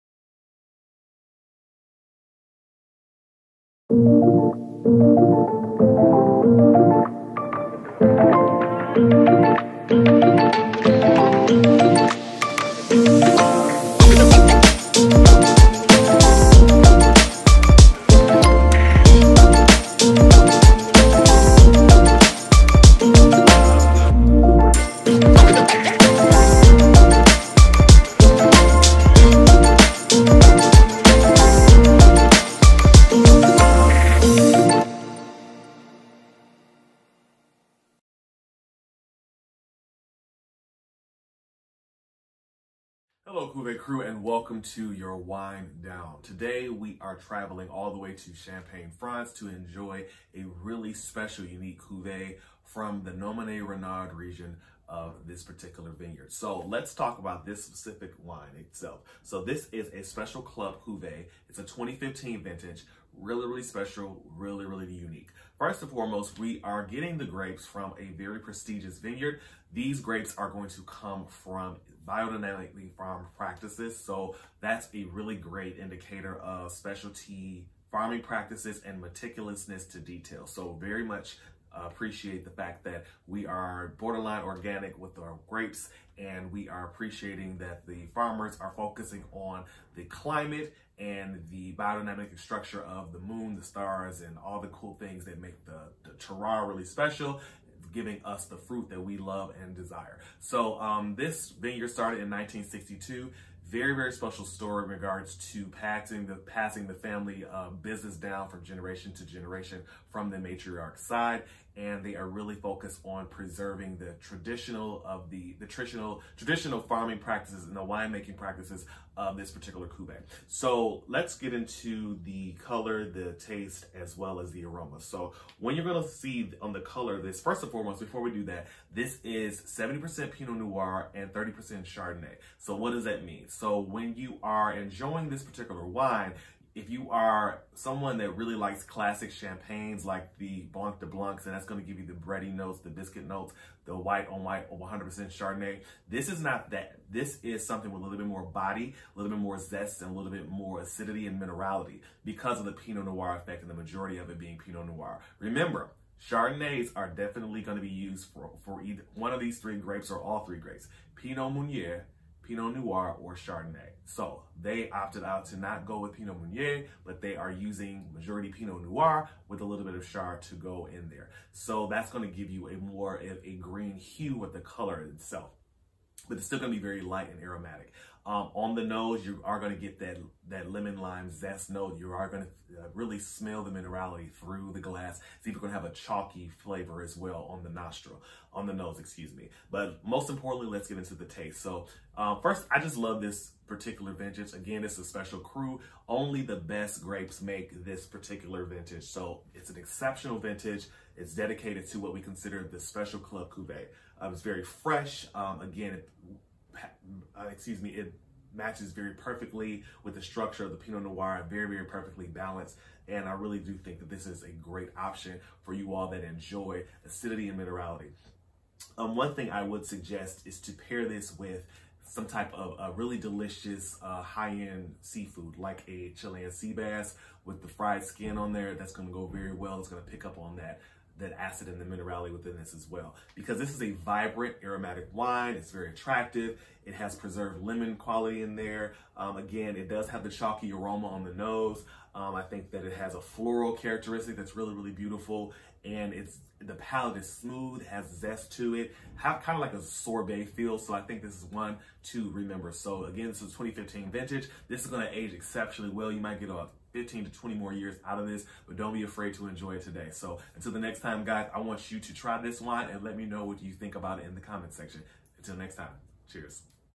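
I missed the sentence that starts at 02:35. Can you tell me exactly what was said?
Remember, Chardonnays are definitely going to be used for, for either one of these three grapes or all three grapes.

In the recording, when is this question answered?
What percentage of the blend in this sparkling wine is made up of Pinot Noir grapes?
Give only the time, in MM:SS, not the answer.
02:09.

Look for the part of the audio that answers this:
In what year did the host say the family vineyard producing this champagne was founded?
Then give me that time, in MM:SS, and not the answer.
01:42.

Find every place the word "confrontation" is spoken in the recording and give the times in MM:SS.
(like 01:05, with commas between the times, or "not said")
not said.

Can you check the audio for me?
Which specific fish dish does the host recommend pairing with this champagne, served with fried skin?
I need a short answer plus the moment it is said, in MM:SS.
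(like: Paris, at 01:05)
Chilean sea bass, at 03:46.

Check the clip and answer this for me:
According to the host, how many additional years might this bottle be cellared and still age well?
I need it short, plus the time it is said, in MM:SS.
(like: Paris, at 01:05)
15 to 20, at 04:16.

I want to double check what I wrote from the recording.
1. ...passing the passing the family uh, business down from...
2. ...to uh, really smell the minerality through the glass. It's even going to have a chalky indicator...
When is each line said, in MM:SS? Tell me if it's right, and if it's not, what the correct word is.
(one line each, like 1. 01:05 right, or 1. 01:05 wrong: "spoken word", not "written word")
1. 01:45 right
2. 03:02 wrong: "flavor", not "indicator".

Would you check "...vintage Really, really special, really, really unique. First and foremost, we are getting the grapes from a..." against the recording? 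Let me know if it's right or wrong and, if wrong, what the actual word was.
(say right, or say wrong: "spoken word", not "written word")
right.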